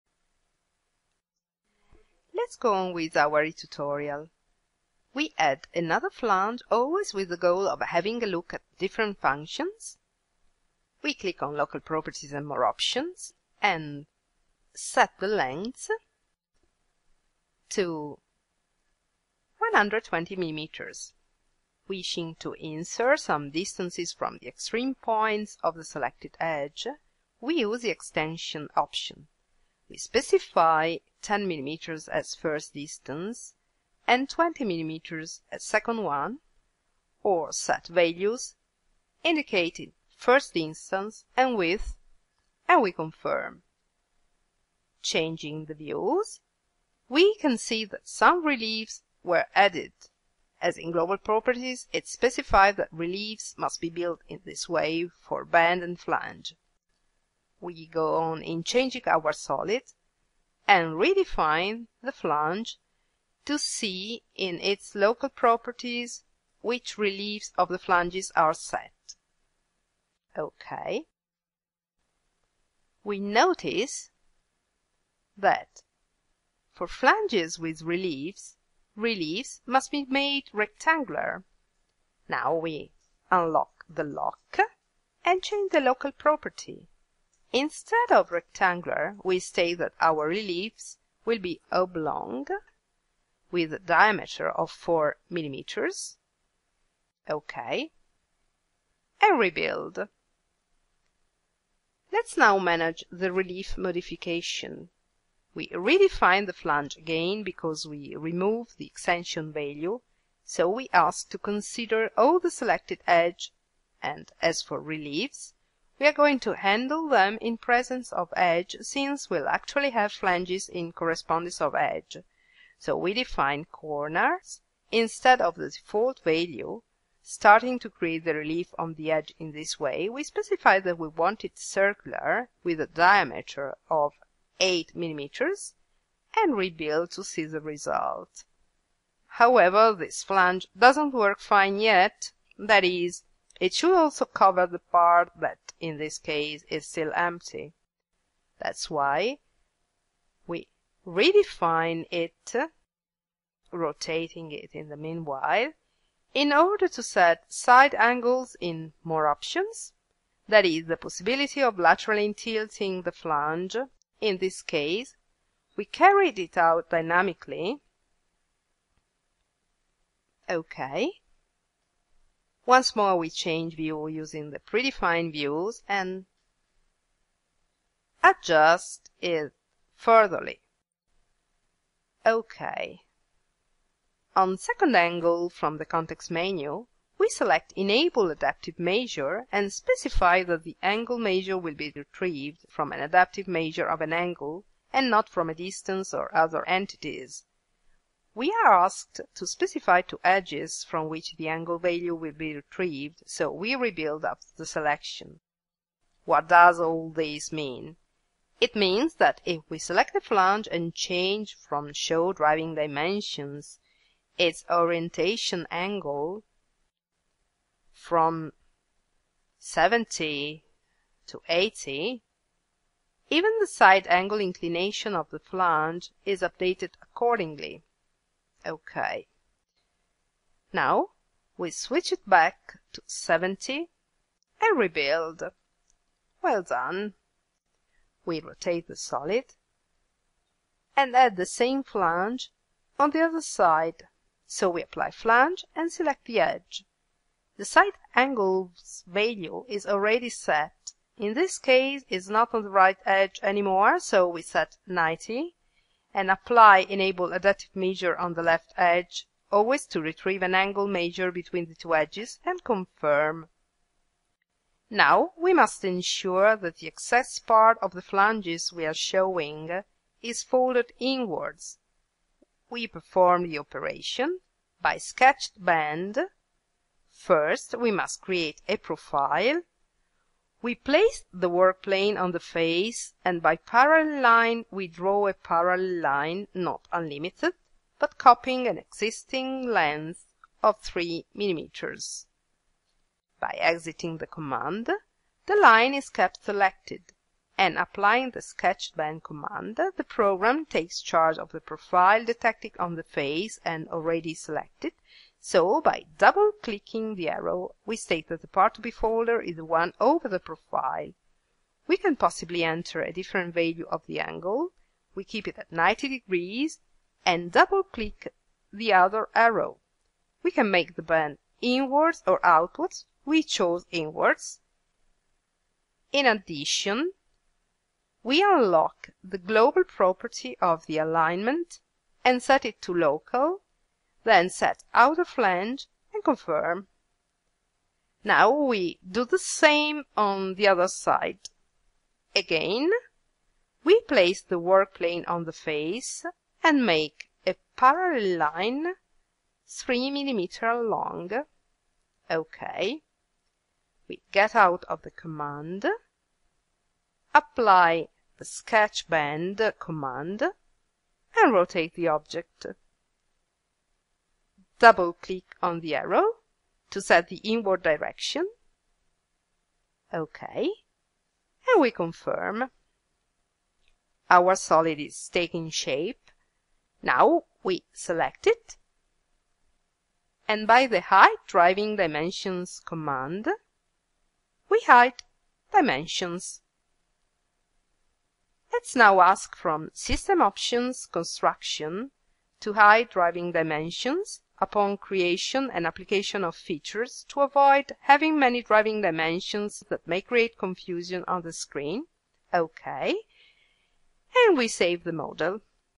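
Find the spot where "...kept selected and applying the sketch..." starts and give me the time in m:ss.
4:56.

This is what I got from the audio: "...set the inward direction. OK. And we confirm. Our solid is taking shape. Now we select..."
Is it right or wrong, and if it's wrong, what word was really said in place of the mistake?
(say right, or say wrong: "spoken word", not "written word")
right.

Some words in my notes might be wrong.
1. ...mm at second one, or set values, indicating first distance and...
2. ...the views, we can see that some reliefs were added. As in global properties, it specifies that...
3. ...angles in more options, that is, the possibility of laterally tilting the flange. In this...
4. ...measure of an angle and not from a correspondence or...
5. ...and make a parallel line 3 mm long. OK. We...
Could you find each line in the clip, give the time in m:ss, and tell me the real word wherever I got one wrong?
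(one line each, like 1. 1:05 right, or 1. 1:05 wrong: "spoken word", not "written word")
1. 0:34 right
2. 0:45 right
3. 2:37 right
4. 3:13 wrong: "distance", not "correspondence"
5. 5:46 right.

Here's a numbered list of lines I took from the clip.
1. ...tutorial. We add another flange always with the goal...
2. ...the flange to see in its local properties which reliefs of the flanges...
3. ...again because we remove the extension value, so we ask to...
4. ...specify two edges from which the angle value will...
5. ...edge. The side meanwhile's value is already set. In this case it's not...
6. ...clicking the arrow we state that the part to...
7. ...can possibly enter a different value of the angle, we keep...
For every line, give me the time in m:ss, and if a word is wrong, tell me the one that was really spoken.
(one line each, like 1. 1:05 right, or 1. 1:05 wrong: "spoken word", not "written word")
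1. 0:03 right
2. 1:02 right
3. 1:46 right
4. 3:19 right
5. 4:06 wrong: "angle", not "meanwhile"
6. 5:06 right
7. 5:11 right.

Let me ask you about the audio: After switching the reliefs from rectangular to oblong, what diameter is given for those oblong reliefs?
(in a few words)
4 millimeters.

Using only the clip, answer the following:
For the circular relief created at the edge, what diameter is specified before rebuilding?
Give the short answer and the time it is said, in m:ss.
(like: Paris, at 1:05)
8 millimeters, at 2:14.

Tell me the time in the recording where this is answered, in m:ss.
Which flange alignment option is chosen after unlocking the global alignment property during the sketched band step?
5:34.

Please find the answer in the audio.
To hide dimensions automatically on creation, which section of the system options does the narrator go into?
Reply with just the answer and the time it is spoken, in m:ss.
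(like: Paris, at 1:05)
construction, at 6:31.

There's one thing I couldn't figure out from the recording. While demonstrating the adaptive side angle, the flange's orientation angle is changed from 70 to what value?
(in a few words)
80.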